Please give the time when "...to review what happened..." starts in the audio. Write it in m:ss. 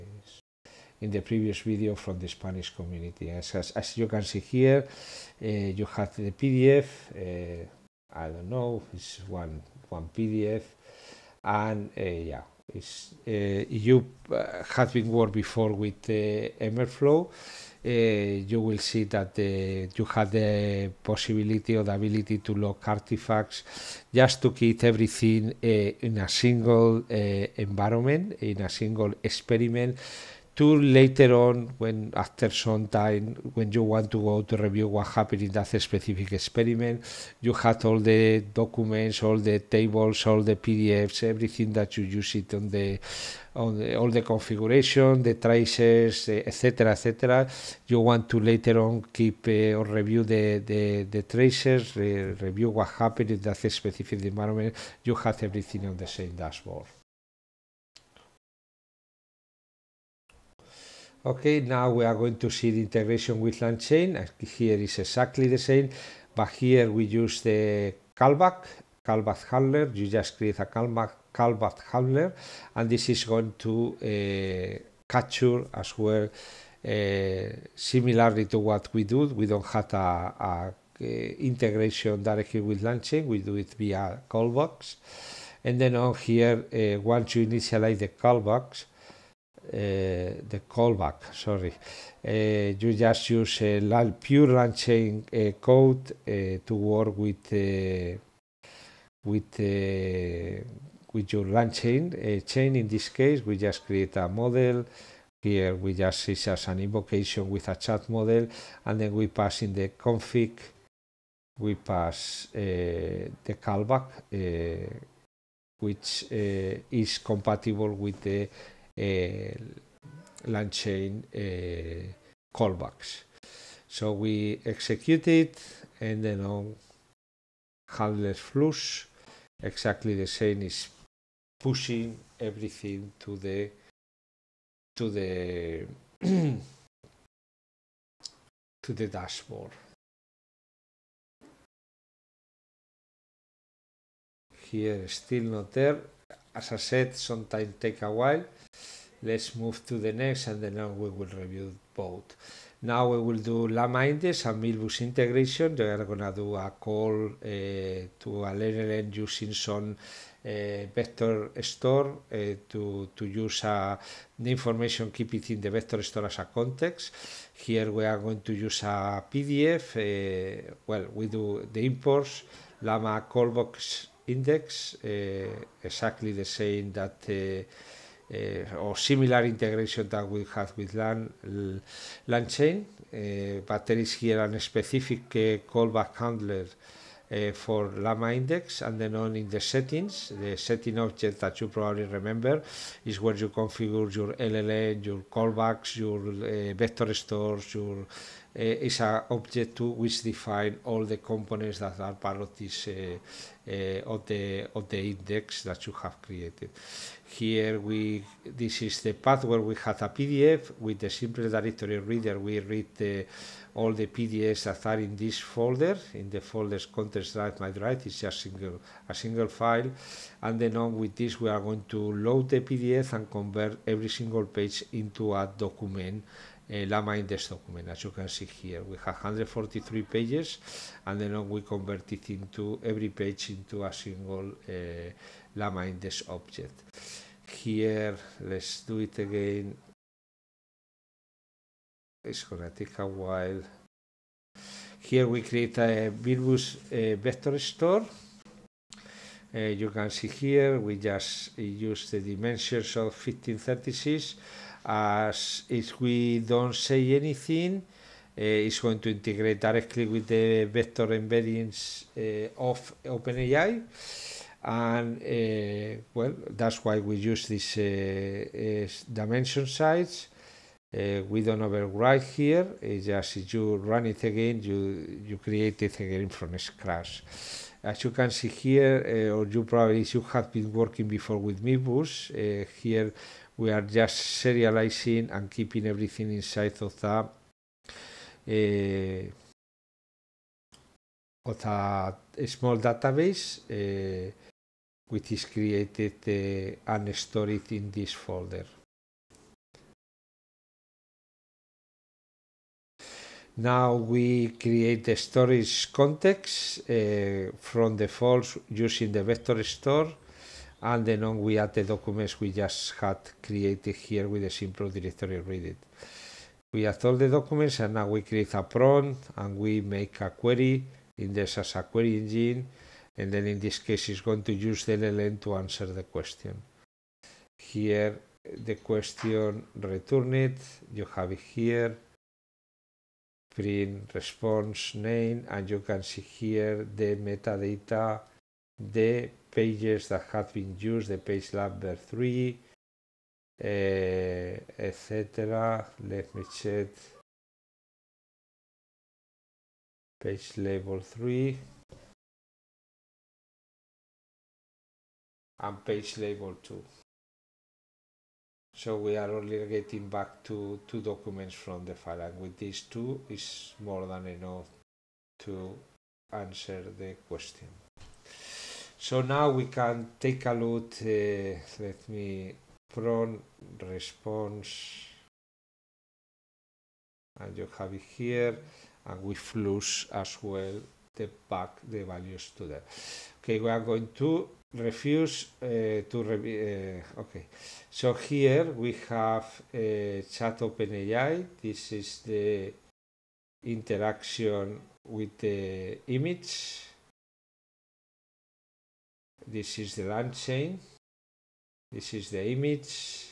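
0:34.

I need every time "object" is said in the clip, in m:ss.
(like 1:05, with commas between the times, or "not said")
3:10, 3:19, 3:56.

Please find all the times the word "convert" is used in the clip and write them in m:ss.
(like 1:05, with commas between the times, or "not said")
3:43, 3:51.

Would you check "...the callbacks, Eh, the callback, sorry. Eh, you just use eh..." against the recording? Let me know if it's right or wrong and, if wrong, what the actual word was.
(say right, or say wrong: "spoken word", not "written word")
right.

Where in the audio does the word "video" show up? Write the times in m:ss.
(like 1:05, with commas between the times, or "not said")
0:01.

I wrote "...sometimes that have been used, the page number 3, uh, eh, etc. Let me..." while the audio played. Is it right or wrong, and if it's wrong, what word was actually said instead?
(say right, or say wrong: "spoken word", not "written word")
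wrong: "pages", not "sometimes".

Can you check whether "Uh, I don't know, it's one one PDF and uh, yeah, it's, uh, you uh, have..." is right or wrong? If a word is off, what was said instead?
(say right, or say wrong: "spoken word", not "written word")
right.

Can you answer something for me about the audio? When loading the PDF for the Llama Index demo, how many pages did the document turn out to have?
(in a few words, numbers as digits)
143.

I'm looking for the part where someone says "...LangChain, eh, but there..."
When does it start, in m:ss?
3:02.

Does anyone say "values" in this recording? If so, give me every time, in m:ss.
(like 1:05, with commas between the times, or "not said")
6:22.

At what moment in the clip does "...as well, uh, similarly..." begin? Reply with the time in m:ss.
1:15.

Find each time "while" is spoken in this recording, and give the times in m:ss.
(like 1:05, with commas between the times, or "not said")
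2:28, 4:03.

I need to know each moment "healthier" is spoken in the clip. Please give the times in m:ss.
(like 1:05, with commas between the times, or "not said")
not said.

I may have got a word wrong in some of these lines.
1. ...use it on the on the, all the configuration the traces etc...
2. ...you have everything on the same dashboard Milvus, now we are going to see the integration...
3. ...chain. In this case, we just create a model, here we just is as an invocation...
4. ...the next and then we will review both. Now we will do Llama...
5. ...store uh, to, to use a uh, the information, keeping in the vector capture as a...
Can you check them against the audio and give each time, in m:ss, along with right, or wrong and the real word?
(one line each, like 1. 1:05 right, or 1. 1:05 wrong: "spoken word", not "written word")
1. 0:42 right
2. 0:55 wrong: "Okay", not "Milvus"
3. 1:42 right
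4. 2:29 right
5. 2:41 wrong: "store", not "capture".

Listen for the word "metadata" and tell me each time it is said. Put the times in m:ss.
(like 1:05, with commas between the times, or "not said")
5:37.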